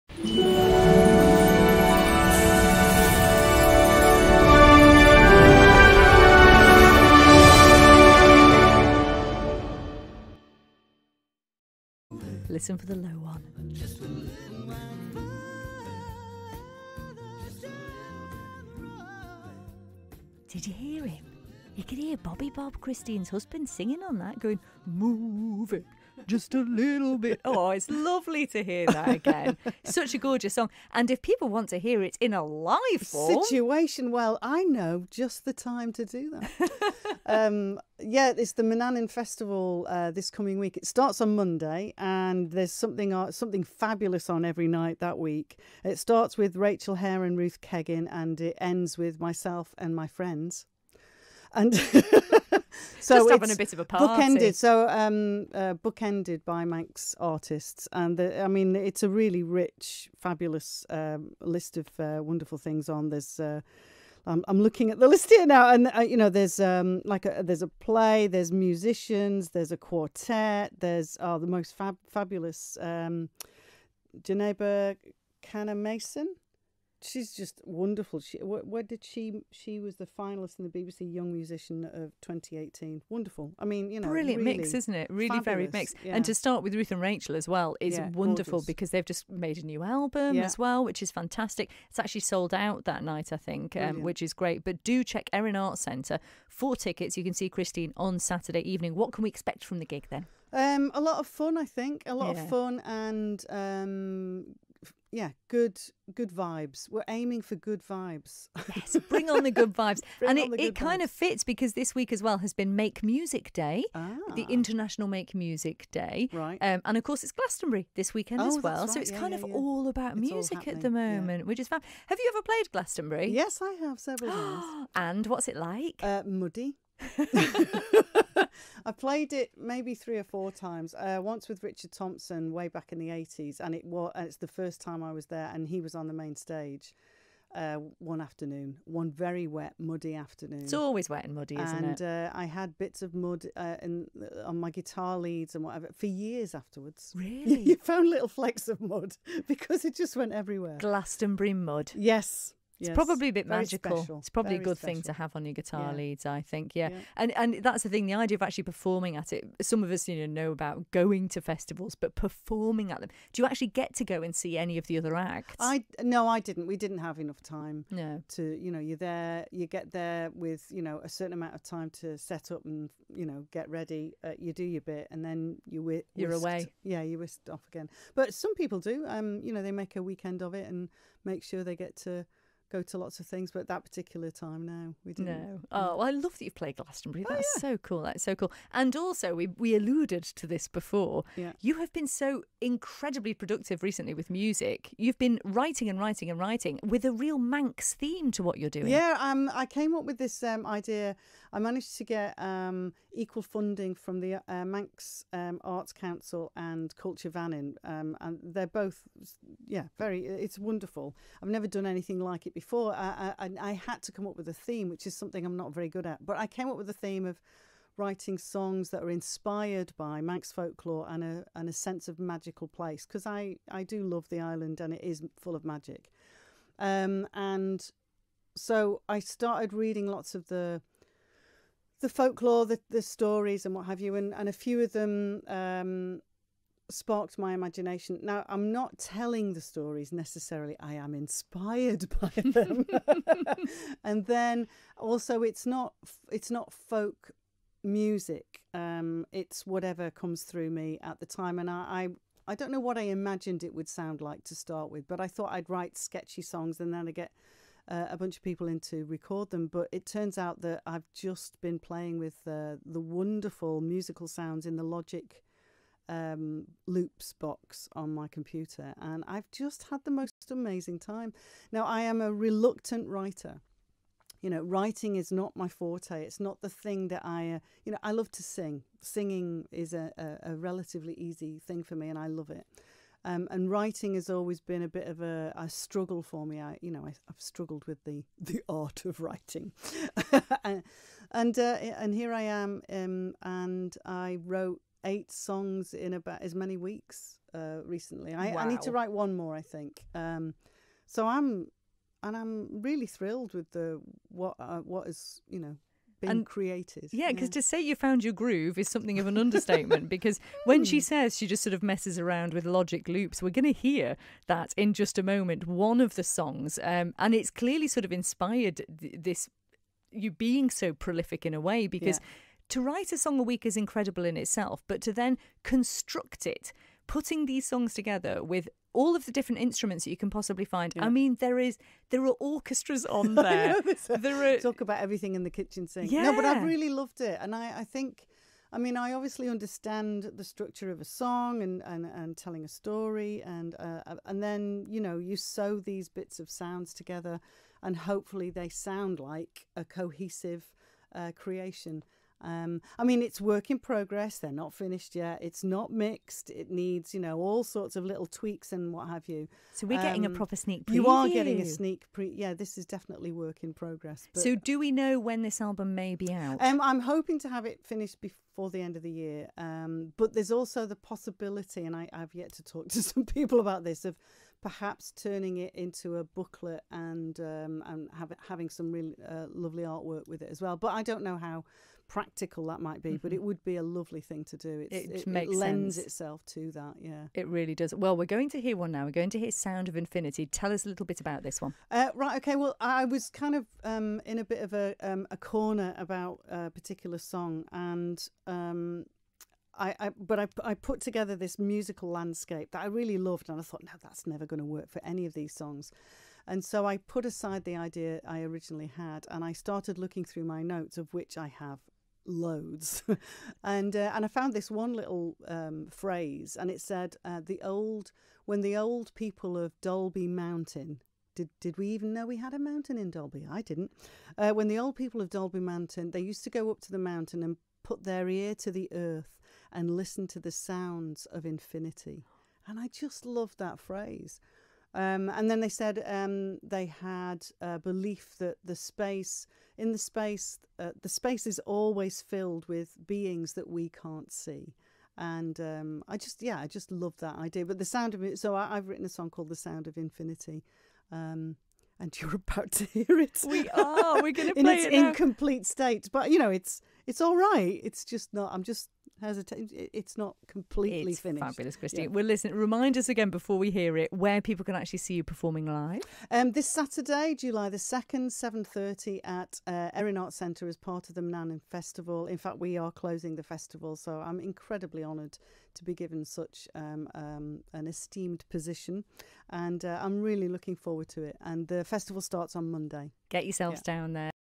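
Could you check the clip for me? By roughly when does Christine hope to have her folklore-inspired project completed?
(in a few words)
end of the year.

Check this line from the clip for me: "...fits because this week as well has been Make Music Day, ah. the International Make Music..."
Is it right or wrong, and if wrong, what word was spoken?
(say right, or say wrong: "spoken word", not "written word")
right.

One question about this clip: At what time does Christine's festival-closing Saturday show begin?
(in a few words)
7:30.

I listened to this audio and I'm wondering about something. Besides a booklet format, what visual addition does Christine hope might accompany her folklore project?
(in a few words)
artwork.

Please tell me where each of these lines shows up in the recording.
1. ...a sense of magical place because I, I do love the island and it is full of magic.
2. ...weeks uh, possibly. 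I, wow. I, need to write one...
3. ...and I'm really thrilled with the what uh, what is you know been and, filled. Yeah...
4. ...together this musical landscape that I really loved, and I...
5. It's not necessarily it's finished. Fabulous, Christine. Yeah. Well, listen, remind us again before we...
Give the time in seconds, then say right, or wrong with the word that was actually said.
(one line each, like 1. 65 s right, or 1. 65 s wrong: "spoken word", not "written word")
1. 221 s right
2. 296 s wrong: "recently", not "possibly"
3. 302 s wrong: "created", not "filled"
4. 401 s right
5. 459 s wrong: "completely", not "necessarily".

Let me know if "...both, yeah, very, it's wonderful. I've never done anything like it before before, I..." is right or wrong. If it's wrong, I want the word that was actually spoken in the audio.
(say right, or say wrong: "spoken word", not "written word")
right.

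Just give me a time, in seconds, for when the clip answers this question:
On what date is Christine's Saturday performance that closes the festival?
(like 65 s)
467 s.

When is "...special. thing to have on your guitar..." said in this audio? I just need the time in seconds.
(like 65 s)
154 s.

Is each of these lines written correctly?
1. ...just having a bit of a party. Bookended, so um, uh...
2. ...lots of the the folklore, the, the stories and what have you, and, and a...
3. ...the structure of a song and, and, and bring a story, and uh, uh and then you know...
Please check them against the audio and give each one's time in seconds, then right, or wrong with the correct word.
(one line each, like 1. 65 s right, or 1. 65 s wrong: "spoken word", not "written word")
1. 53 s right
2. 230 s right
3. 340 s wrong: "telling", not "bring".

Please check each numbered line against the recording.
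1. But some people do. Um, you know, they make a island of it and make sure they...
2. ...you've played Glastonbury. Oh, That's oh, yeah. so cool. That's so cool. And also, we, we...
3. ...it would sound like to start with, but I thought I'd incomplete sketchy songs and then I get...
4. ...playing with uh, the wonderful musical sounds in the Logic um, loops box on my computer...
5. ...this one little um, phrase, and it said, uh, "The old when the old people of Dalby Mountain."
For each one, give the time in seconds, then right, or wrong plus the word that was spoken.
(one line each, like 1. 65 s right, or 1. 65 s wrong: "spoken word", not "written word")
1. 178 s wrong: "weekend", not "island"
2. 186 s right
3. 253 s wrong: "write", not "incomplete"
4. 261 s right
5. 414 s right.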